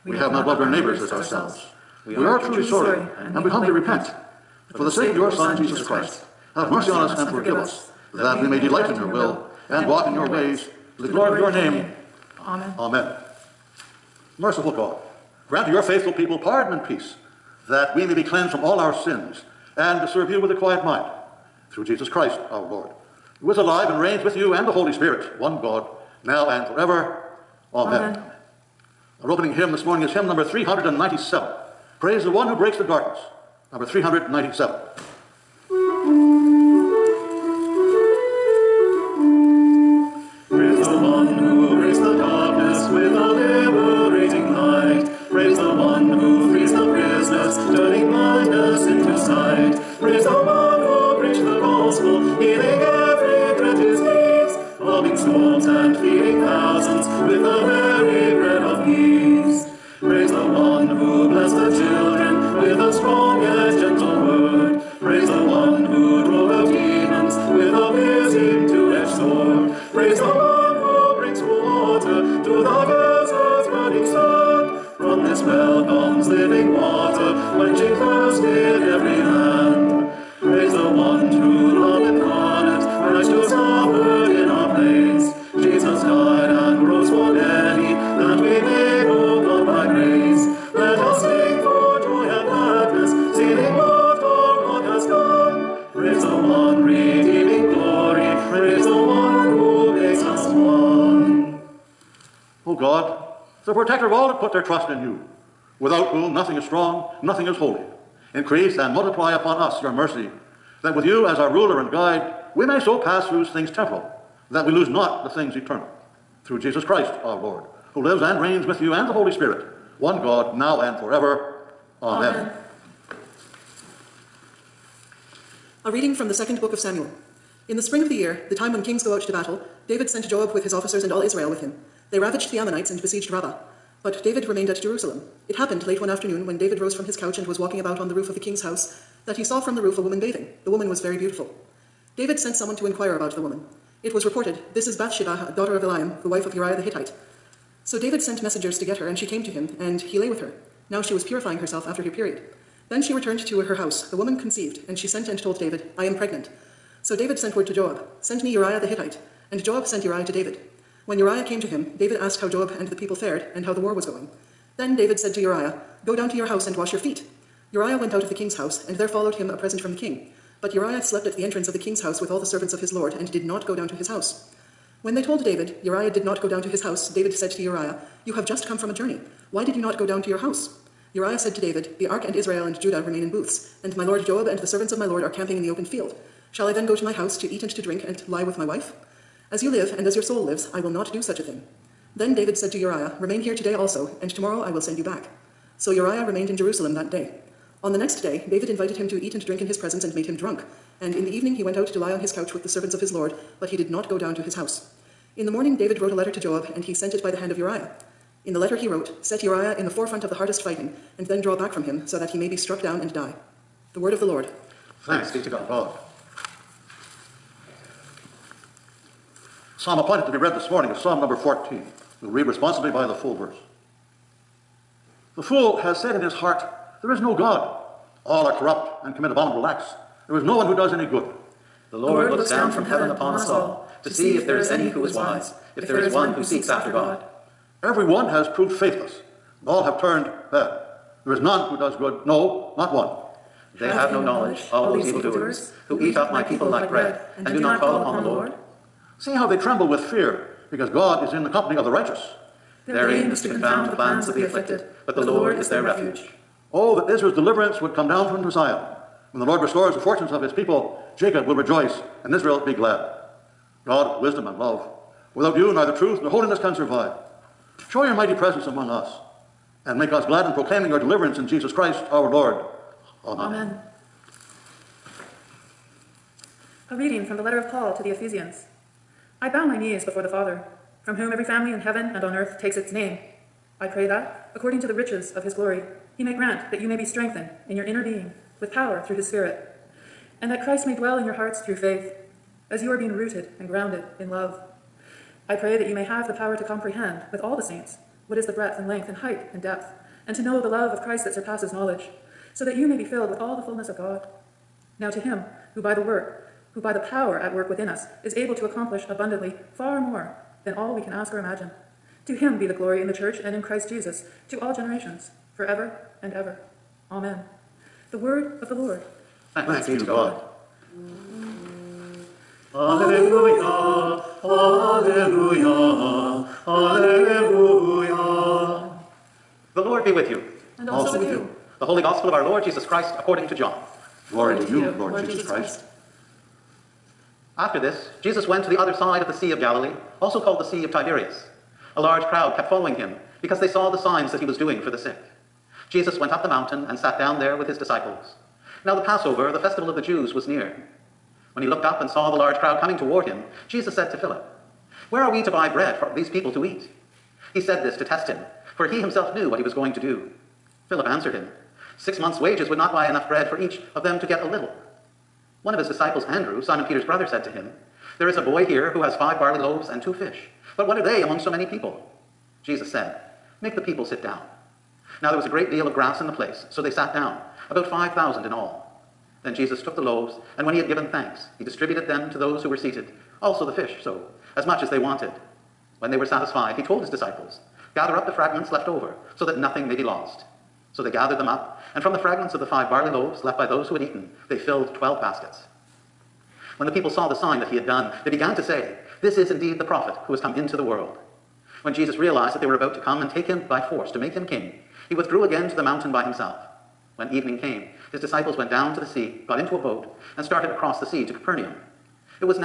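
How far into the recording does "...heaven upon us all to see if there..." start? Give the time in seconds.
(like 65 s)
232 s.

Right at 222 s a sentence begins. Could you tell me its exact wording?
We'll read responsibly by the full verse.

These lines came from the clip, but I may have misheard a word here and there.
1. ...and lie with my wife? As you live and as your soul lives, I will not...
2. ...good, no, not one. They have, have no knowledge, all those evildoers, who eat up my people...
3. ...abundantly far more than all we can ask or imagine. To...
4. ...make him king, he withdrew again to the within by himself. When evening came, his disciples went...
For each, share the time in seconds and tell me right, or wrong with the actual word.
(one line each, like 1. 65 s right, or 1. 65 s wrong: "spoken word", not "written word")
1. 188 s right
2. 241 s right
3. 309 s right
4. 404 s wrong: "mountain", not "within".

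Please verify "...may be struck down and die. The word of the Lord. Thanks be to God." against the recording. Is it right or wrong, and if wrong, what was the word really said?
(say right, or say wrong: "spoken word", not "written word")
right.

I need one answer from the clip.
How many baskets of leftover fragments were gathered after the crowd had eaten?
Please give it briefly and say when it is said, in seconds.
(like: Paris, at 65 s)
12, at 394 s.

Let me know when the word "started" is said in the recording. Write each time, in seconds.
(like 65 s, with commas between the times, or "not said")
410 s.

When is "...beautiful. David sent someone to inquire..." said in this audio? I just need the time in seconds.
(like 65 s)
141 s.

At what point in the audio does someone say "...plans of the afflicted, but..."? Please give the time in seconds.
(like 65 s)
253 s.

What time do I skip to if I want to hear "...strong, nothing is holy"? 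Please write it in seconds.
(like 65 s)
106 s.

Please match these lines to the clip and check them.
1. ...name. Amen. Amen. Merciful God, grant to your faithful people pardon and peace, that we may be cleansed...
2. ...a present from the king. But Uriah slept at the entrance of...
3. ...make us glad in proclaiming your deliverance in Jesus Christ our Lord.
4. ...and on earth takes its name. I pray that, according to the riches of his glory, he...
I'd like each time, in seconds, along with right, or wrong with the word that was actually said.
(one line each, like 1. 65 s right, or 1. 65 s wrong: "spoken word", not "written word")
1. 11 s right
2. 169 s right
3. 269 s right
4. 282 s right.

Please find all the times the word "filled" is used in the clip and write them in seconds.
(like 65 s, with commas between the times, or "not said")
303 s, 394 s.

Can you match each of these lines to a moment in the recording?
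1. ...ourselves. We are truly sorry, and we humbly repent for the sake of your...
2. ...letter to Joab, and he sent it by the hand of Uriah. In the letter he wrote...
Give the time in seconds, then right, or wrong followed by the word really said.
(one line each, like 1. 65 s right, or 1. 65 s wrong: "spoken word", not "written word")
1. 1 s right
2. 206 s right.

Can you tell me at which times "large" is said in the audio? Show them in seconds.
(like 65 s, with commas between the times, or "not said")
342 s, 352 s.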